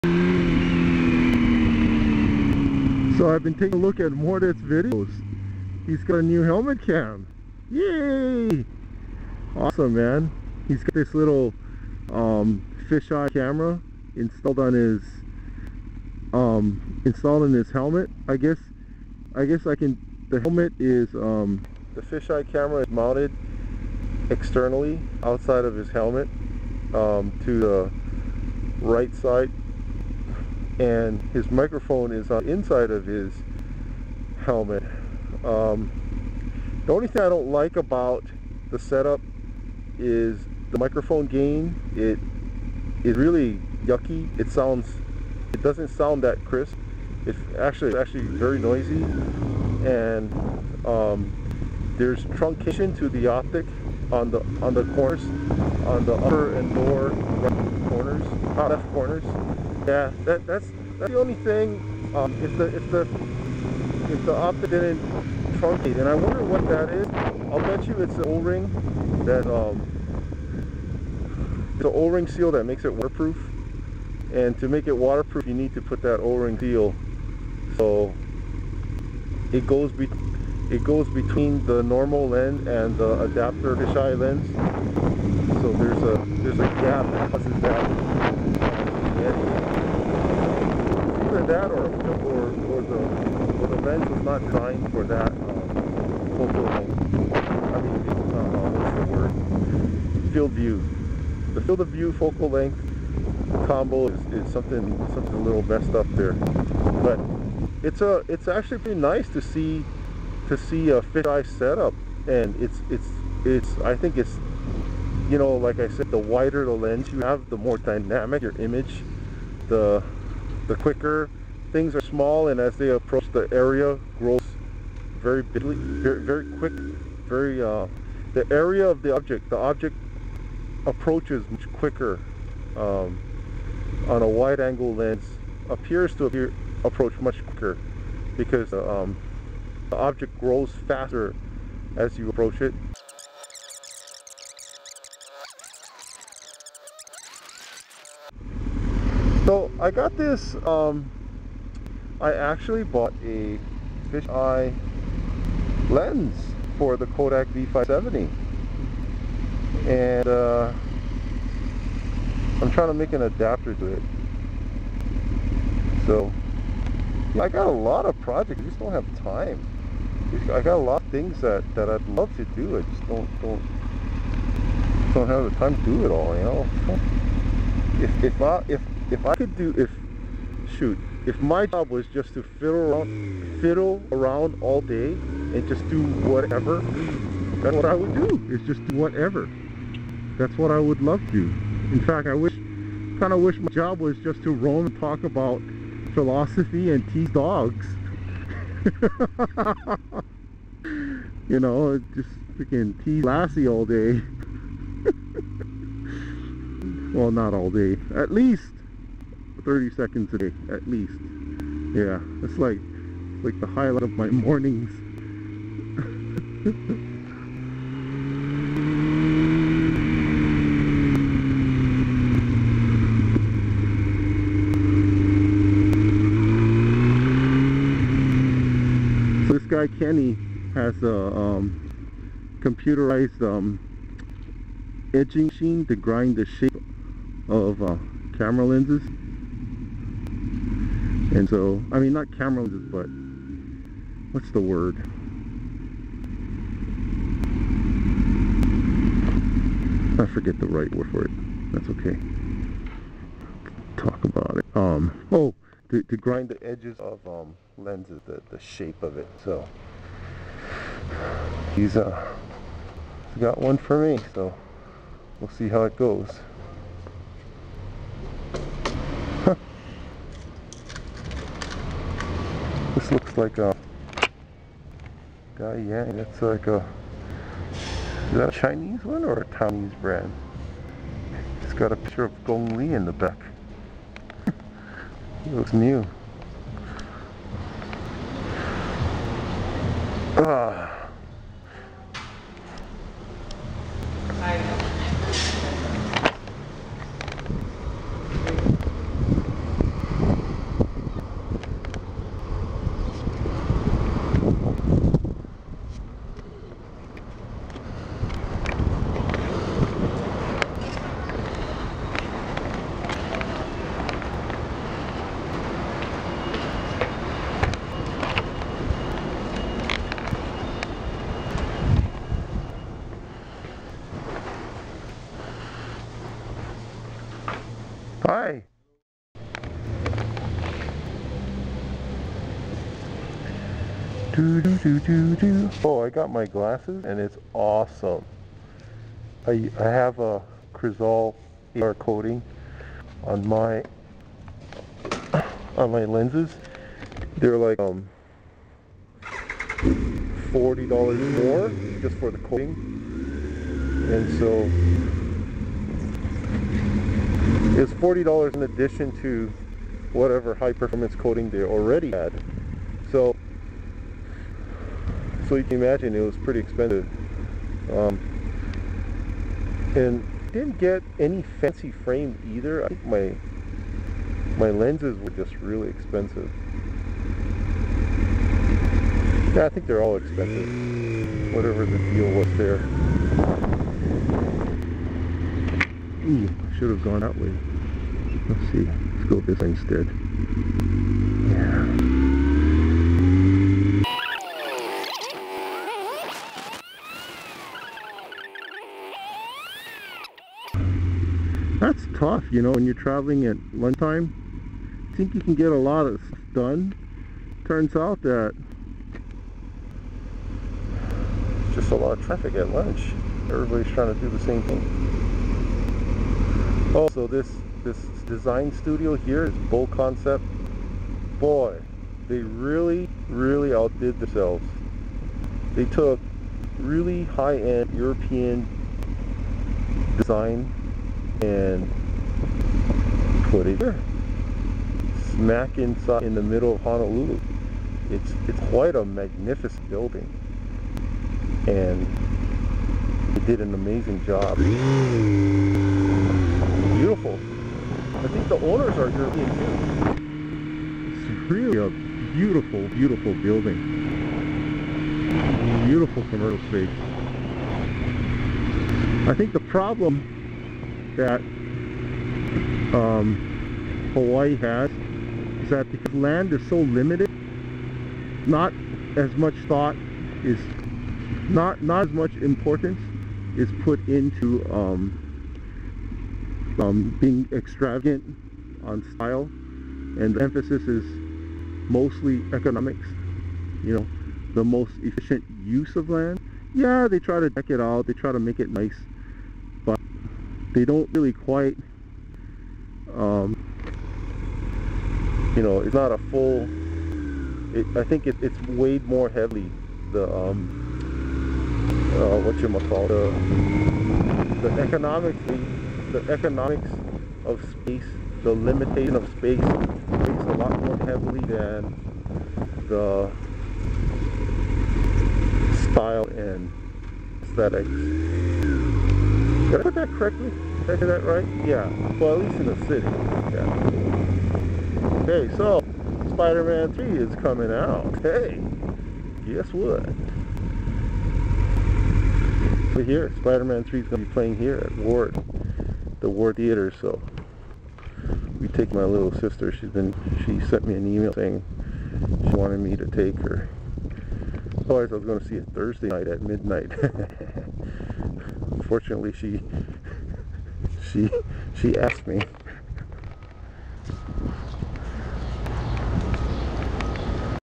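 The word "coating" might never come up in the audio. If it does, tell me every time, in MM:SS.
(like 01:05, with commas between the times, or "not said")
05:41, 05:52, 06:01.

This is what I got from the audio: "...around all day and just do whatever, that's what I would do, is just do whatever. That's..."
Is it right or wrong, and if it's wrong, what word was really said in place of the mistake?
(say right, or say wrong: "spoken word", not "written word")
right.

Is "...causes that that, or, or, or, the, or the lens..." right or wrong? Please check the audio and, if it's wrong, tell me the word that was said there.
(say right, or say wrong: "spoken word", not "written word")
right.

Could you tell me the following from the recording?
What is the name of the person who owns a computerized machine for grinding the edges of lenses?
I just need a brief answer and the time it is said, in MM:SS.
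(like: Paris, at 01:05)
Kenny, at 03:49.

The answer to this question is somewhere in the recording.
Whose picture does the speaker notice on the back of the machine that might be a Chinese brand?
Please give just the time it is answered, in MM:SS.
04:42.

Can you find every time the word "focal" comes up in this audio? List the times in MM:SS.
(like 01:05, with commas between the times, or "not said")
01:36, 01:42.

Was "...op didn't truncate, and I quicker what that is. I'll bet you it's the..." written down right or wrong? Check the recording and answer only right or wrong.
wrong.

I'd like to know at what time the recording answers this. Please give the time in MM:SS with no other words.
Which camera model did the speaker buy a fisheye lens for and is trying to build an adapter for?
02:37.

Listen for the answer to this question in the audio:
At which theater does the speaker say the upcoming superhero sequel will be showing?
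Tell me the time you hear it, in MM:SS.
08:56.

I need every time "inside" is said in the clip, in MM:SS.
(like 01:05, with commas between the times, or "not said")
00:32, 07:15.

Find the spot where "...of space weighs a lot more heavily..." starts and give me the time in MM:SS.
08:29.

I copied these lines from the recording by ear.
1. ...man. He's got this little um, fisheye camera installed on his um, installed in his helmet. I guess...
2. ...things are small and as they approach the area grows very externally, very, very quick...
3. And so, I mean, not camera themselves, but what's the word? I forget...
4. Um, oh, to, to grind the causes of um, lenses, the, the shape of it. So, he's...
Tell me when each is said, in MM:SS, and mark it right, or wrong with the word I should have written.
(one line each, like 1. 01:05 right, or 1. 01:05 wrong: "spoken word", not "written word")
1. 00:09 right
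2. 02:01 wrong: "bigly", not "externally"
3. 04:01 wrong: "lenses", not "themselves"
4. 04:14 wrong: "edges", not "causes".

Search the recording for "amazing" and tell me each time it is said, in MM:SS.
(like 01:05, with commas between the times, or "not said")
07:23.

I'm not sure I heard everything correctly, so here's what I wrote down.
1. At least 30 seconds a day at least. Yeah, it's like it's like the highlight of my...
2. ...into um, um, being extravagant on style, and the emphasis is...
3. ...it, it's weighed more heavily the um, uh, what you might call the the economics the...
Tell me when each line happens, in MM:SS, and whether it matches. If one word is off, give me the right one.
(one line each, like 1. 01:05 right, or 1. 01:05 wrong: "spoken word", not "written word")
1. 03:28 right
2. 07:54 right
3. 08:18 right.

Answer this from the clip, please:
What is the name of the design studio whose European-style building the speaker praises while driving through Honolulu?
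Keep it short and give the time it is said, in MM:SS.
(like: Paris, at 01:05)
BoConcept, at 06:59.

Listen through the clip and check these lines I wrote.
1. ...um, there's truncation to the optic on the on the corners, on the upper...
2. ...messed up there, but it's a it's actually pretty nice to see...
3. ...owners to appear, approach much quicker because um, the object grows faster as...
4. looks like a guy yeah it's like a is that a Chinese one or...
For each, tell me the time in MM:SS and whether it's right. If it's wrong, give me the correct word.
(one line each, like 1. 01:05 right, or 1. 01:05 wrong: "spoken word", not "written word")
1. 00:50 right
2. 01:45 right
3. 02:15 wrong: "appears", not "owners"
4. 04:33 right.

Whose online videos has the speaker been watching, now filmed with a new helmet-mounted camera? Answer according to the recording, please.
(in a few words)
Mordet.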